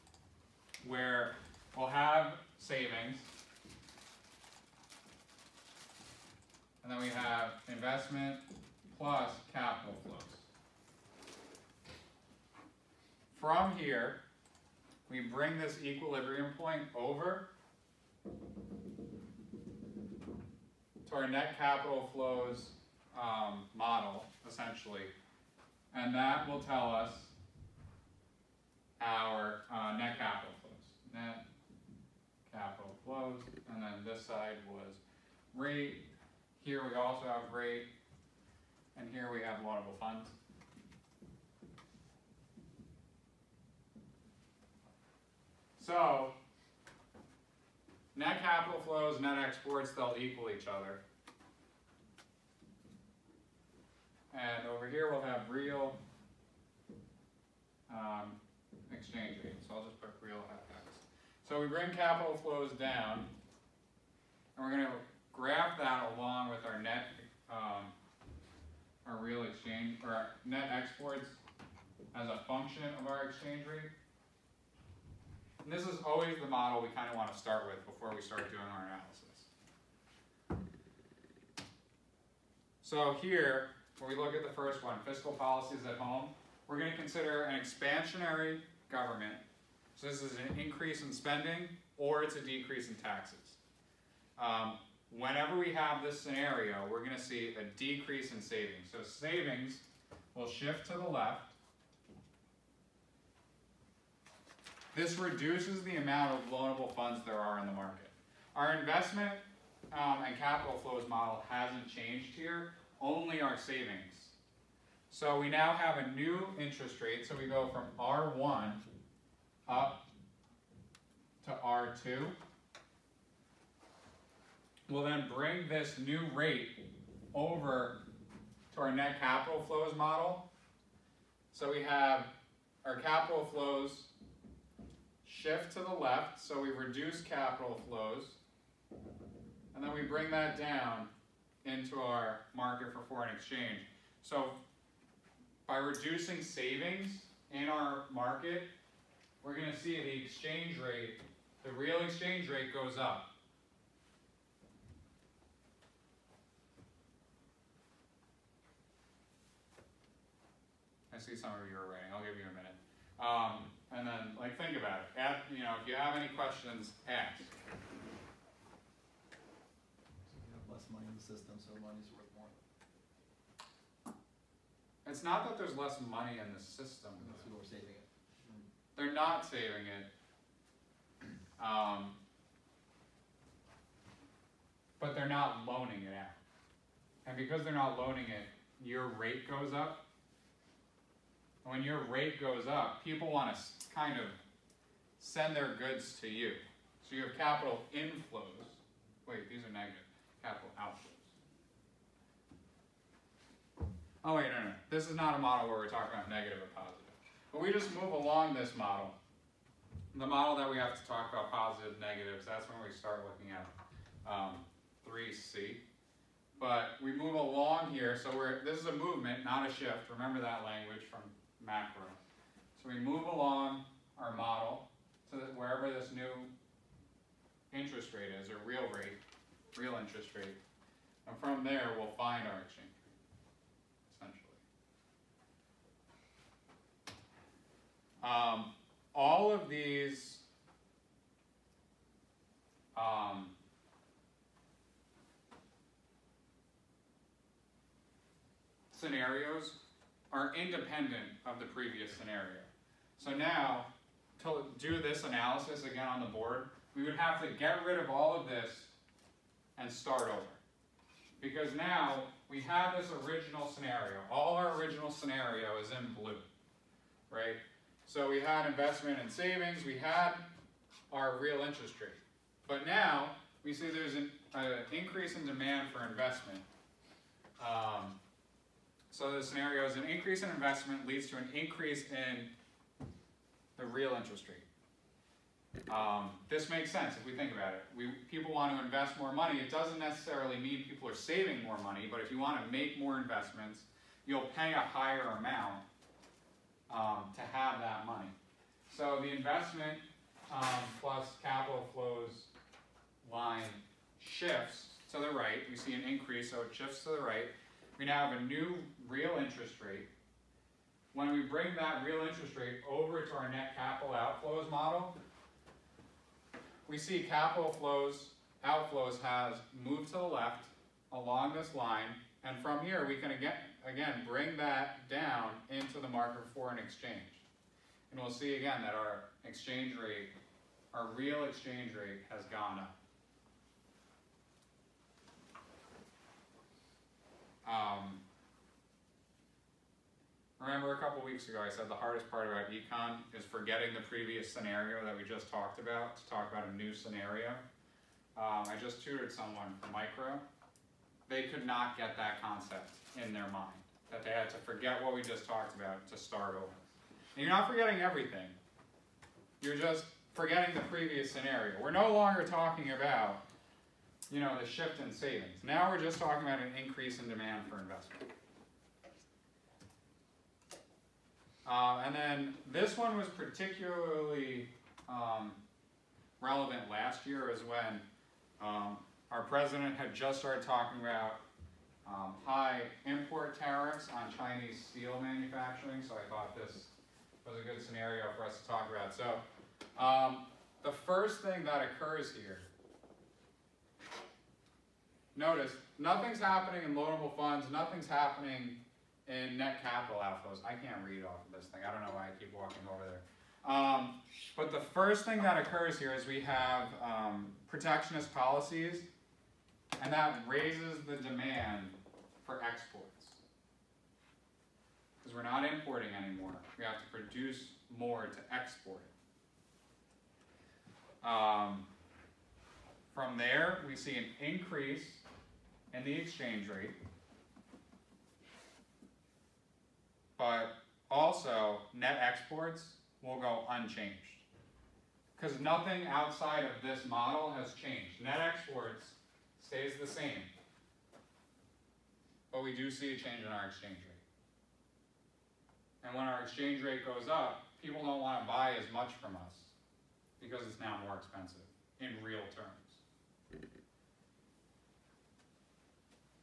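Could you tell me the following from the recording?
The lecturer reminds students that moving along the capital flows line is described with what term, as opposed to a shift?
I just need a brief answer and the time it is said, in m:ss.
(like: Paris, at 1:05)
A movement, at 3:38.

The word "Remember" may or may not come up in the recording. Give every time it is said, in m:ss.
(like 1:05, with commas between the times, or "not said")
3:40, 5:40.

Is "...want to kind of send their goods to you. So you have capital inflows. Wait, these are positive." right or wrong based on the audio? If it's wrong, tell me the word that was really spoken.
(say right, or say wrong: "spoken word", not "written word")
wrong: "negative", not "positive".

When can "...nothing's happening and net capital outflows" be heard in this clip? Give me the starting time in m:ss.
6:37.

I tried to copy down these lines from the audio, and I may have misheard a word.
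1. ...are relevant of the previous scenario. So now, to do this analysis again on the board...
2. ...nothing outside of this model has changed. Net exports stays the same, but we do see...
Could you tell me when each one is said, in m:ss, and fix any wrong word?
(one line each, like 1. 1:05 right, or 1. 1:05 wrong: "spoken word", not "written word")
1. 4:10 wrong: "independent", not "relevant"
2. 7:15 right.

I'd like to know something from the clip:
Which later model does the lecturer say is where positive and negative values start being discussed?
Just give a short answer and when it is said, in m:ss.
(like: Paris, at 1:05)
3C, at 3:35.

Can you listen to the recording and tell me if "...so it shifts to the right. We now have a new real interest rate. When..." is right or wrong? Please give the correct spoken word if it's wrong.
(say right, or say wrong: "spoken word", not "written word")
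right.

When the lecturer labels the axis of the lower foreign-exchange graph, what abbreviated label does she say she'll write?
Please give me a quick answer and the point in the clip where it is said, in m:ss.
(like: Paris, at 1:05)
Real FX, at 1:00.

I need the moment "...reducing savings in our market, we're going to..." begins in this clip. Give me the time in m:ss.
2:25.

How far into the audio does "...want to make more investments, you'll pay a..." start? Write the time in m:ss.
4:52.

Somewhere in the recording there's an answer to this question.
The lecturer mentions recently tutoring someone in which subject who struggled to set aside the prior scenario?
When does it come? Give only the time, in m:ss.
5:49.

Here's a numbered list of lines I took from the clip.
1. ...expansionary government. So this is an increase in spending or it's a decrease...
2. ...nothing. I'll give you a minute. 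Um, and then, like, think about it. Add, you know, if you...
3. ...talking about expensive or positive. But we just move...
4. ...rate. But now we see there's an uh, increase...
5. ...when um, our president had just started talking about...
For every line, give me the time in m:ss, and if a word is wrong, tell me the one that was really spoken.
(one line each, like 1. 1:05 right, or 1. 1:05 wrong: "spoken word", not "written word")
1. 1:27 right
2. 2:41 wrong: "writing", not "nothing"
3. 3:25 wrong: "negative", not "expensive"
4. 4:31 right
5. 6:17 right.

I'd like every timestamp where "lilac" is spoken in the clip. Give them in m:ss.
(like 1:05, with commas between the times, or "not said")
not said.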